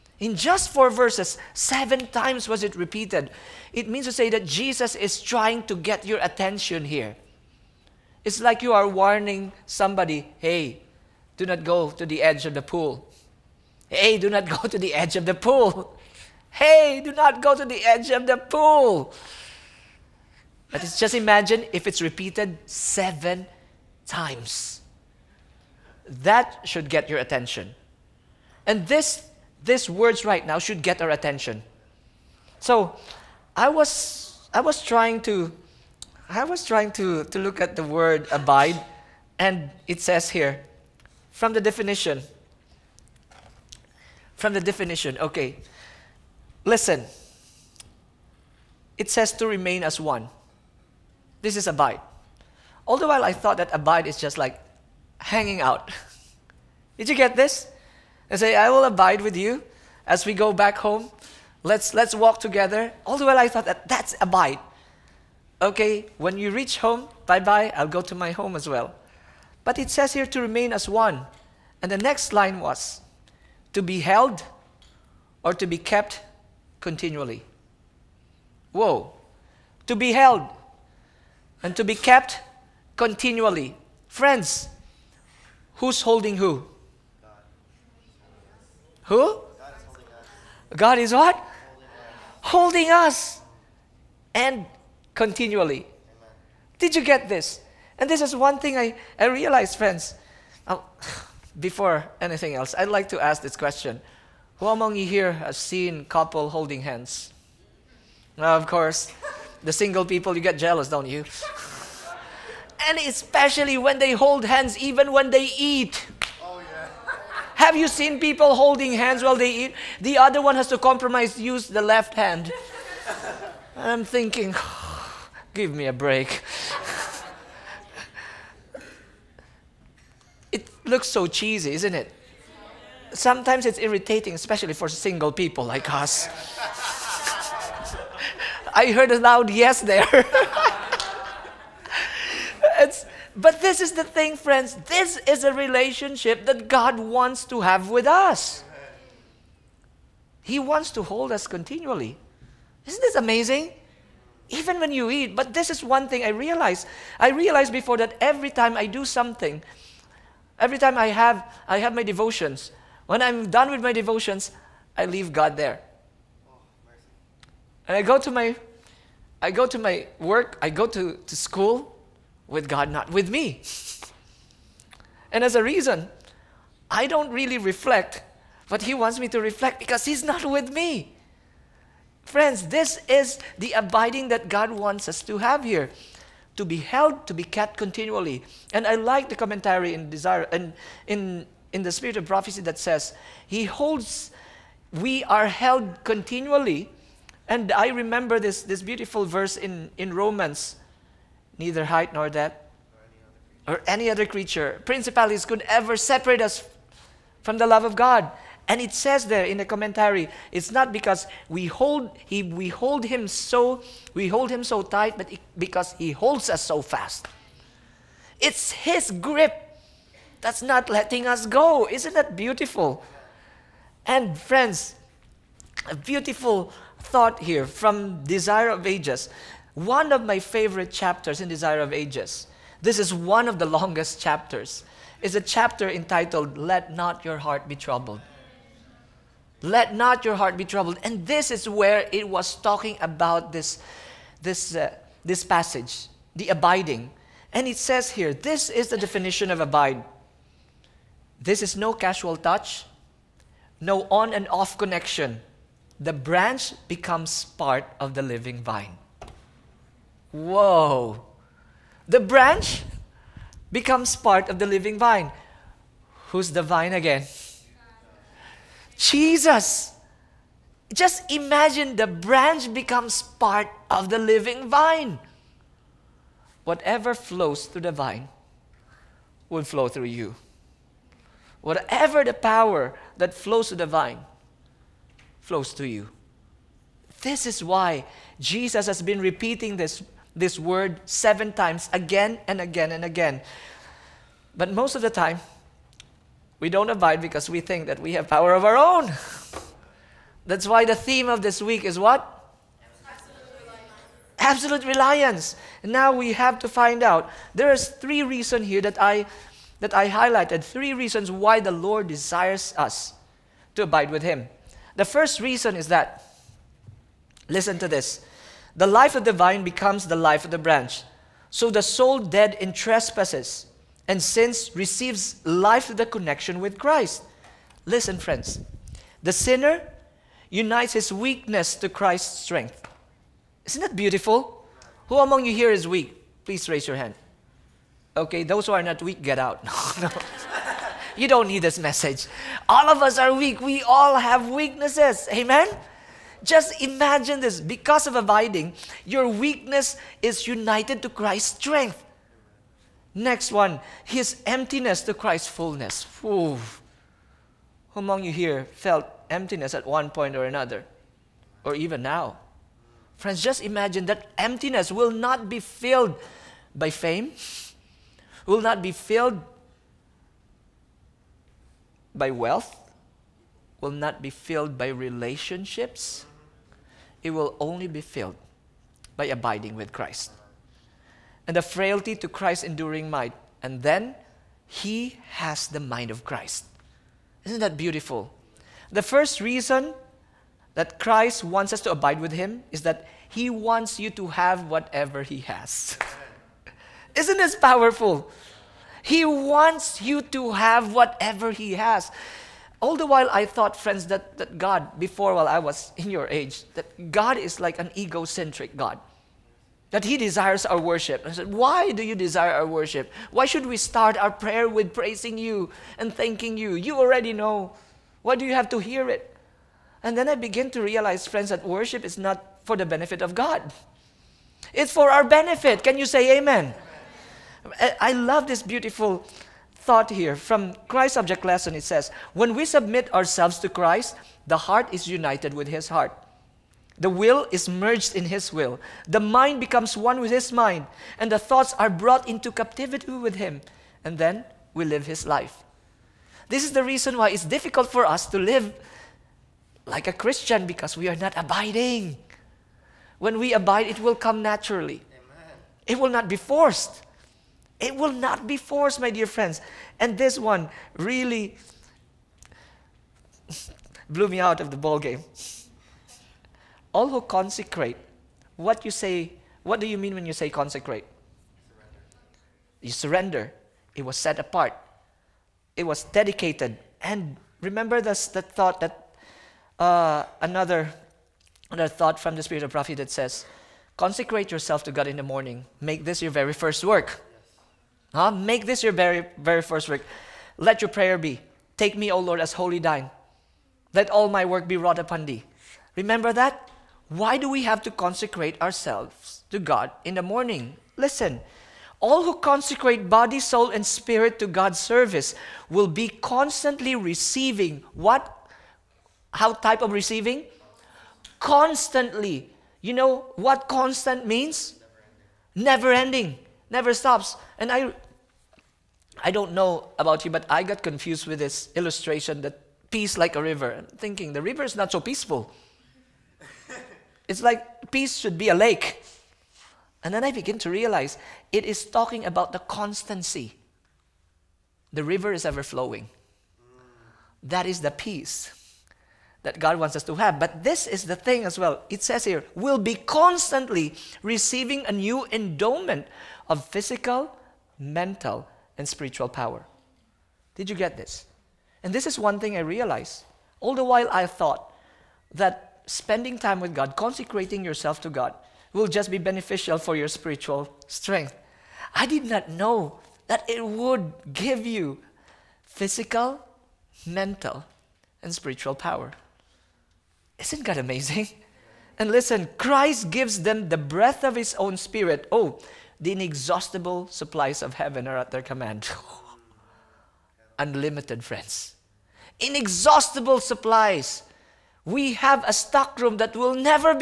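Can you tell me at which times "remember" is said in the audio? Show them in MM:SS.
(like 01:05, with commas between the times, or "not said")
03:17, 07:57, 08:15.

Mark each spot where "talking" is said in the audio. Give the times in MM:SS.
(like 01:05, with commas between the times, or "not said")
04:02, 08:51.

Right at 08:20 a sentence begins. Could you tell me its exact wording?
Listen, all who consecrate body, soul, and spirit to God's service will be constantly receiving what?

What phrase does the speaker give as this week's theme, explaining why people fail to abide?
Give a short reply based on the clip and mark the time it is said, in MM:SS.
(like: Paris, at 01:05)
Absolute reliance, at 05:04.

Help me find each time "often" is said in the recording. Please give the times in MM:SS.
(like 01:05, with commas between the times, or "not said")
not said.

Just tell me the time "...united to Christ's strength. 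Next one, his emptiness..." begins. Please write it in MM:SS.
05:50.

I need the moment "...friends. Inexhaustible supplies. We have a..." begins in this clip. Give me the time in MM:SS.
09:41.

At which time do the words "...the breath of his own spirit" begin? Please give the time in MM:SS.
09:33.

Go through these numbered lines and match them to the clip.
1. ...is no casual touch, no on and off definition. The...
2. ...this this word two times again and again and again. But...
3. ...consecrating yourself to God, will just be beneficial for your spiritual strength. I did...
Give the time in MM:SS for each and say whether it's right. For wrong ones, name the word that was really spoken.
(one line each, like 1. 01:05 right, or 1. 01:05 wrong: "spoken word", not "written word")
1. 04:11 wrong: "connection", not "definition"
2. 04:49 wrong: "seven", not "two"
3. 09:16 right.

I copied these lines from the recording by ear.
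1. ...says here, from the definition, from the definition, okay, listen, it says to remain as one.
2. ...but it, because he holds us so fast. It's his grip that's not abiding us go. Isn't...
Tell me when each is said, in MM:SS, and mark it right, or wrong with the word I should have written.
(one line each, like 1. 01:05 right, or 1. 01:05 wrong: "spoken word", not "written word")
1. 00:40 right
2. 03:35 wrong: "letting", not "abiding".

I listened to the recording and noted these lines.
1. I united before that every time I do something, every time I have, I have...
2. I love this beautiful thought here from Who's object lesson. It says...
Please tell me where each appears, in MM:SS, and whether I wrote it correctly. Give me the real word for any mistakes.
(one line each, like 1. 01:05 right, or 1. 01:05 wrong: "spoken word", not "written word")
1. 02:37 wrong: "realized", not "united"
2. 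07:07 wrong: "Christ", not "Who".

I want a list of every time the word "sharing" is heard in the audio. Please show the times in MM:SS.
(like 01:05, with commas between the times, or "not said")
not said.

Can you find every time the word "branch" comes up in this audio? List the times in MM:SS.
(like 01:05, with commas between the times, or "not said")
04:16, 04:22, 04:32, 05:20.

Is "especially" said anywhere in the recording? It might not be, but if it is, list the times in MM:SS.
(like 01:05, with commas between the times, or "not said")
01:52, 02:14.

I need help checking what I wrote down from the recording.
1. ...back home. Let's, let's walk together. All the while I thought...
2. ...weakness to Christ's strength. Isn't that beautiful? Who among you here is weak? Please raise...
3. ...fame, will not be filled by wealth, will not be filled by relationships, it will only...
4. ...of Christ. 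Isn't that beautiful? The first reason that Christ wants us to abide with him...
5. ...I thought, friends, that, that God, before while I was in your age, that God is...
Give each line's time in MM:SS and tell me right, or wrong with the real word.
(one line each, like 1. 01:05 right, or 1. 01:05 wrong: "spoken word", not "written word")
1. 01:00 right
2. 05:31 right
3. 06:06 right
4. 06:26 right
5. 06:43 right.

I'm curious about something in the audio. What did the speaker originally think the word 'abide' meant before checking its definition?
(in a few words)
hanging out.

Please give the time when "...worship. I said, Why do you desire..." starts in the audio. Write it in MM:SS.
06:50.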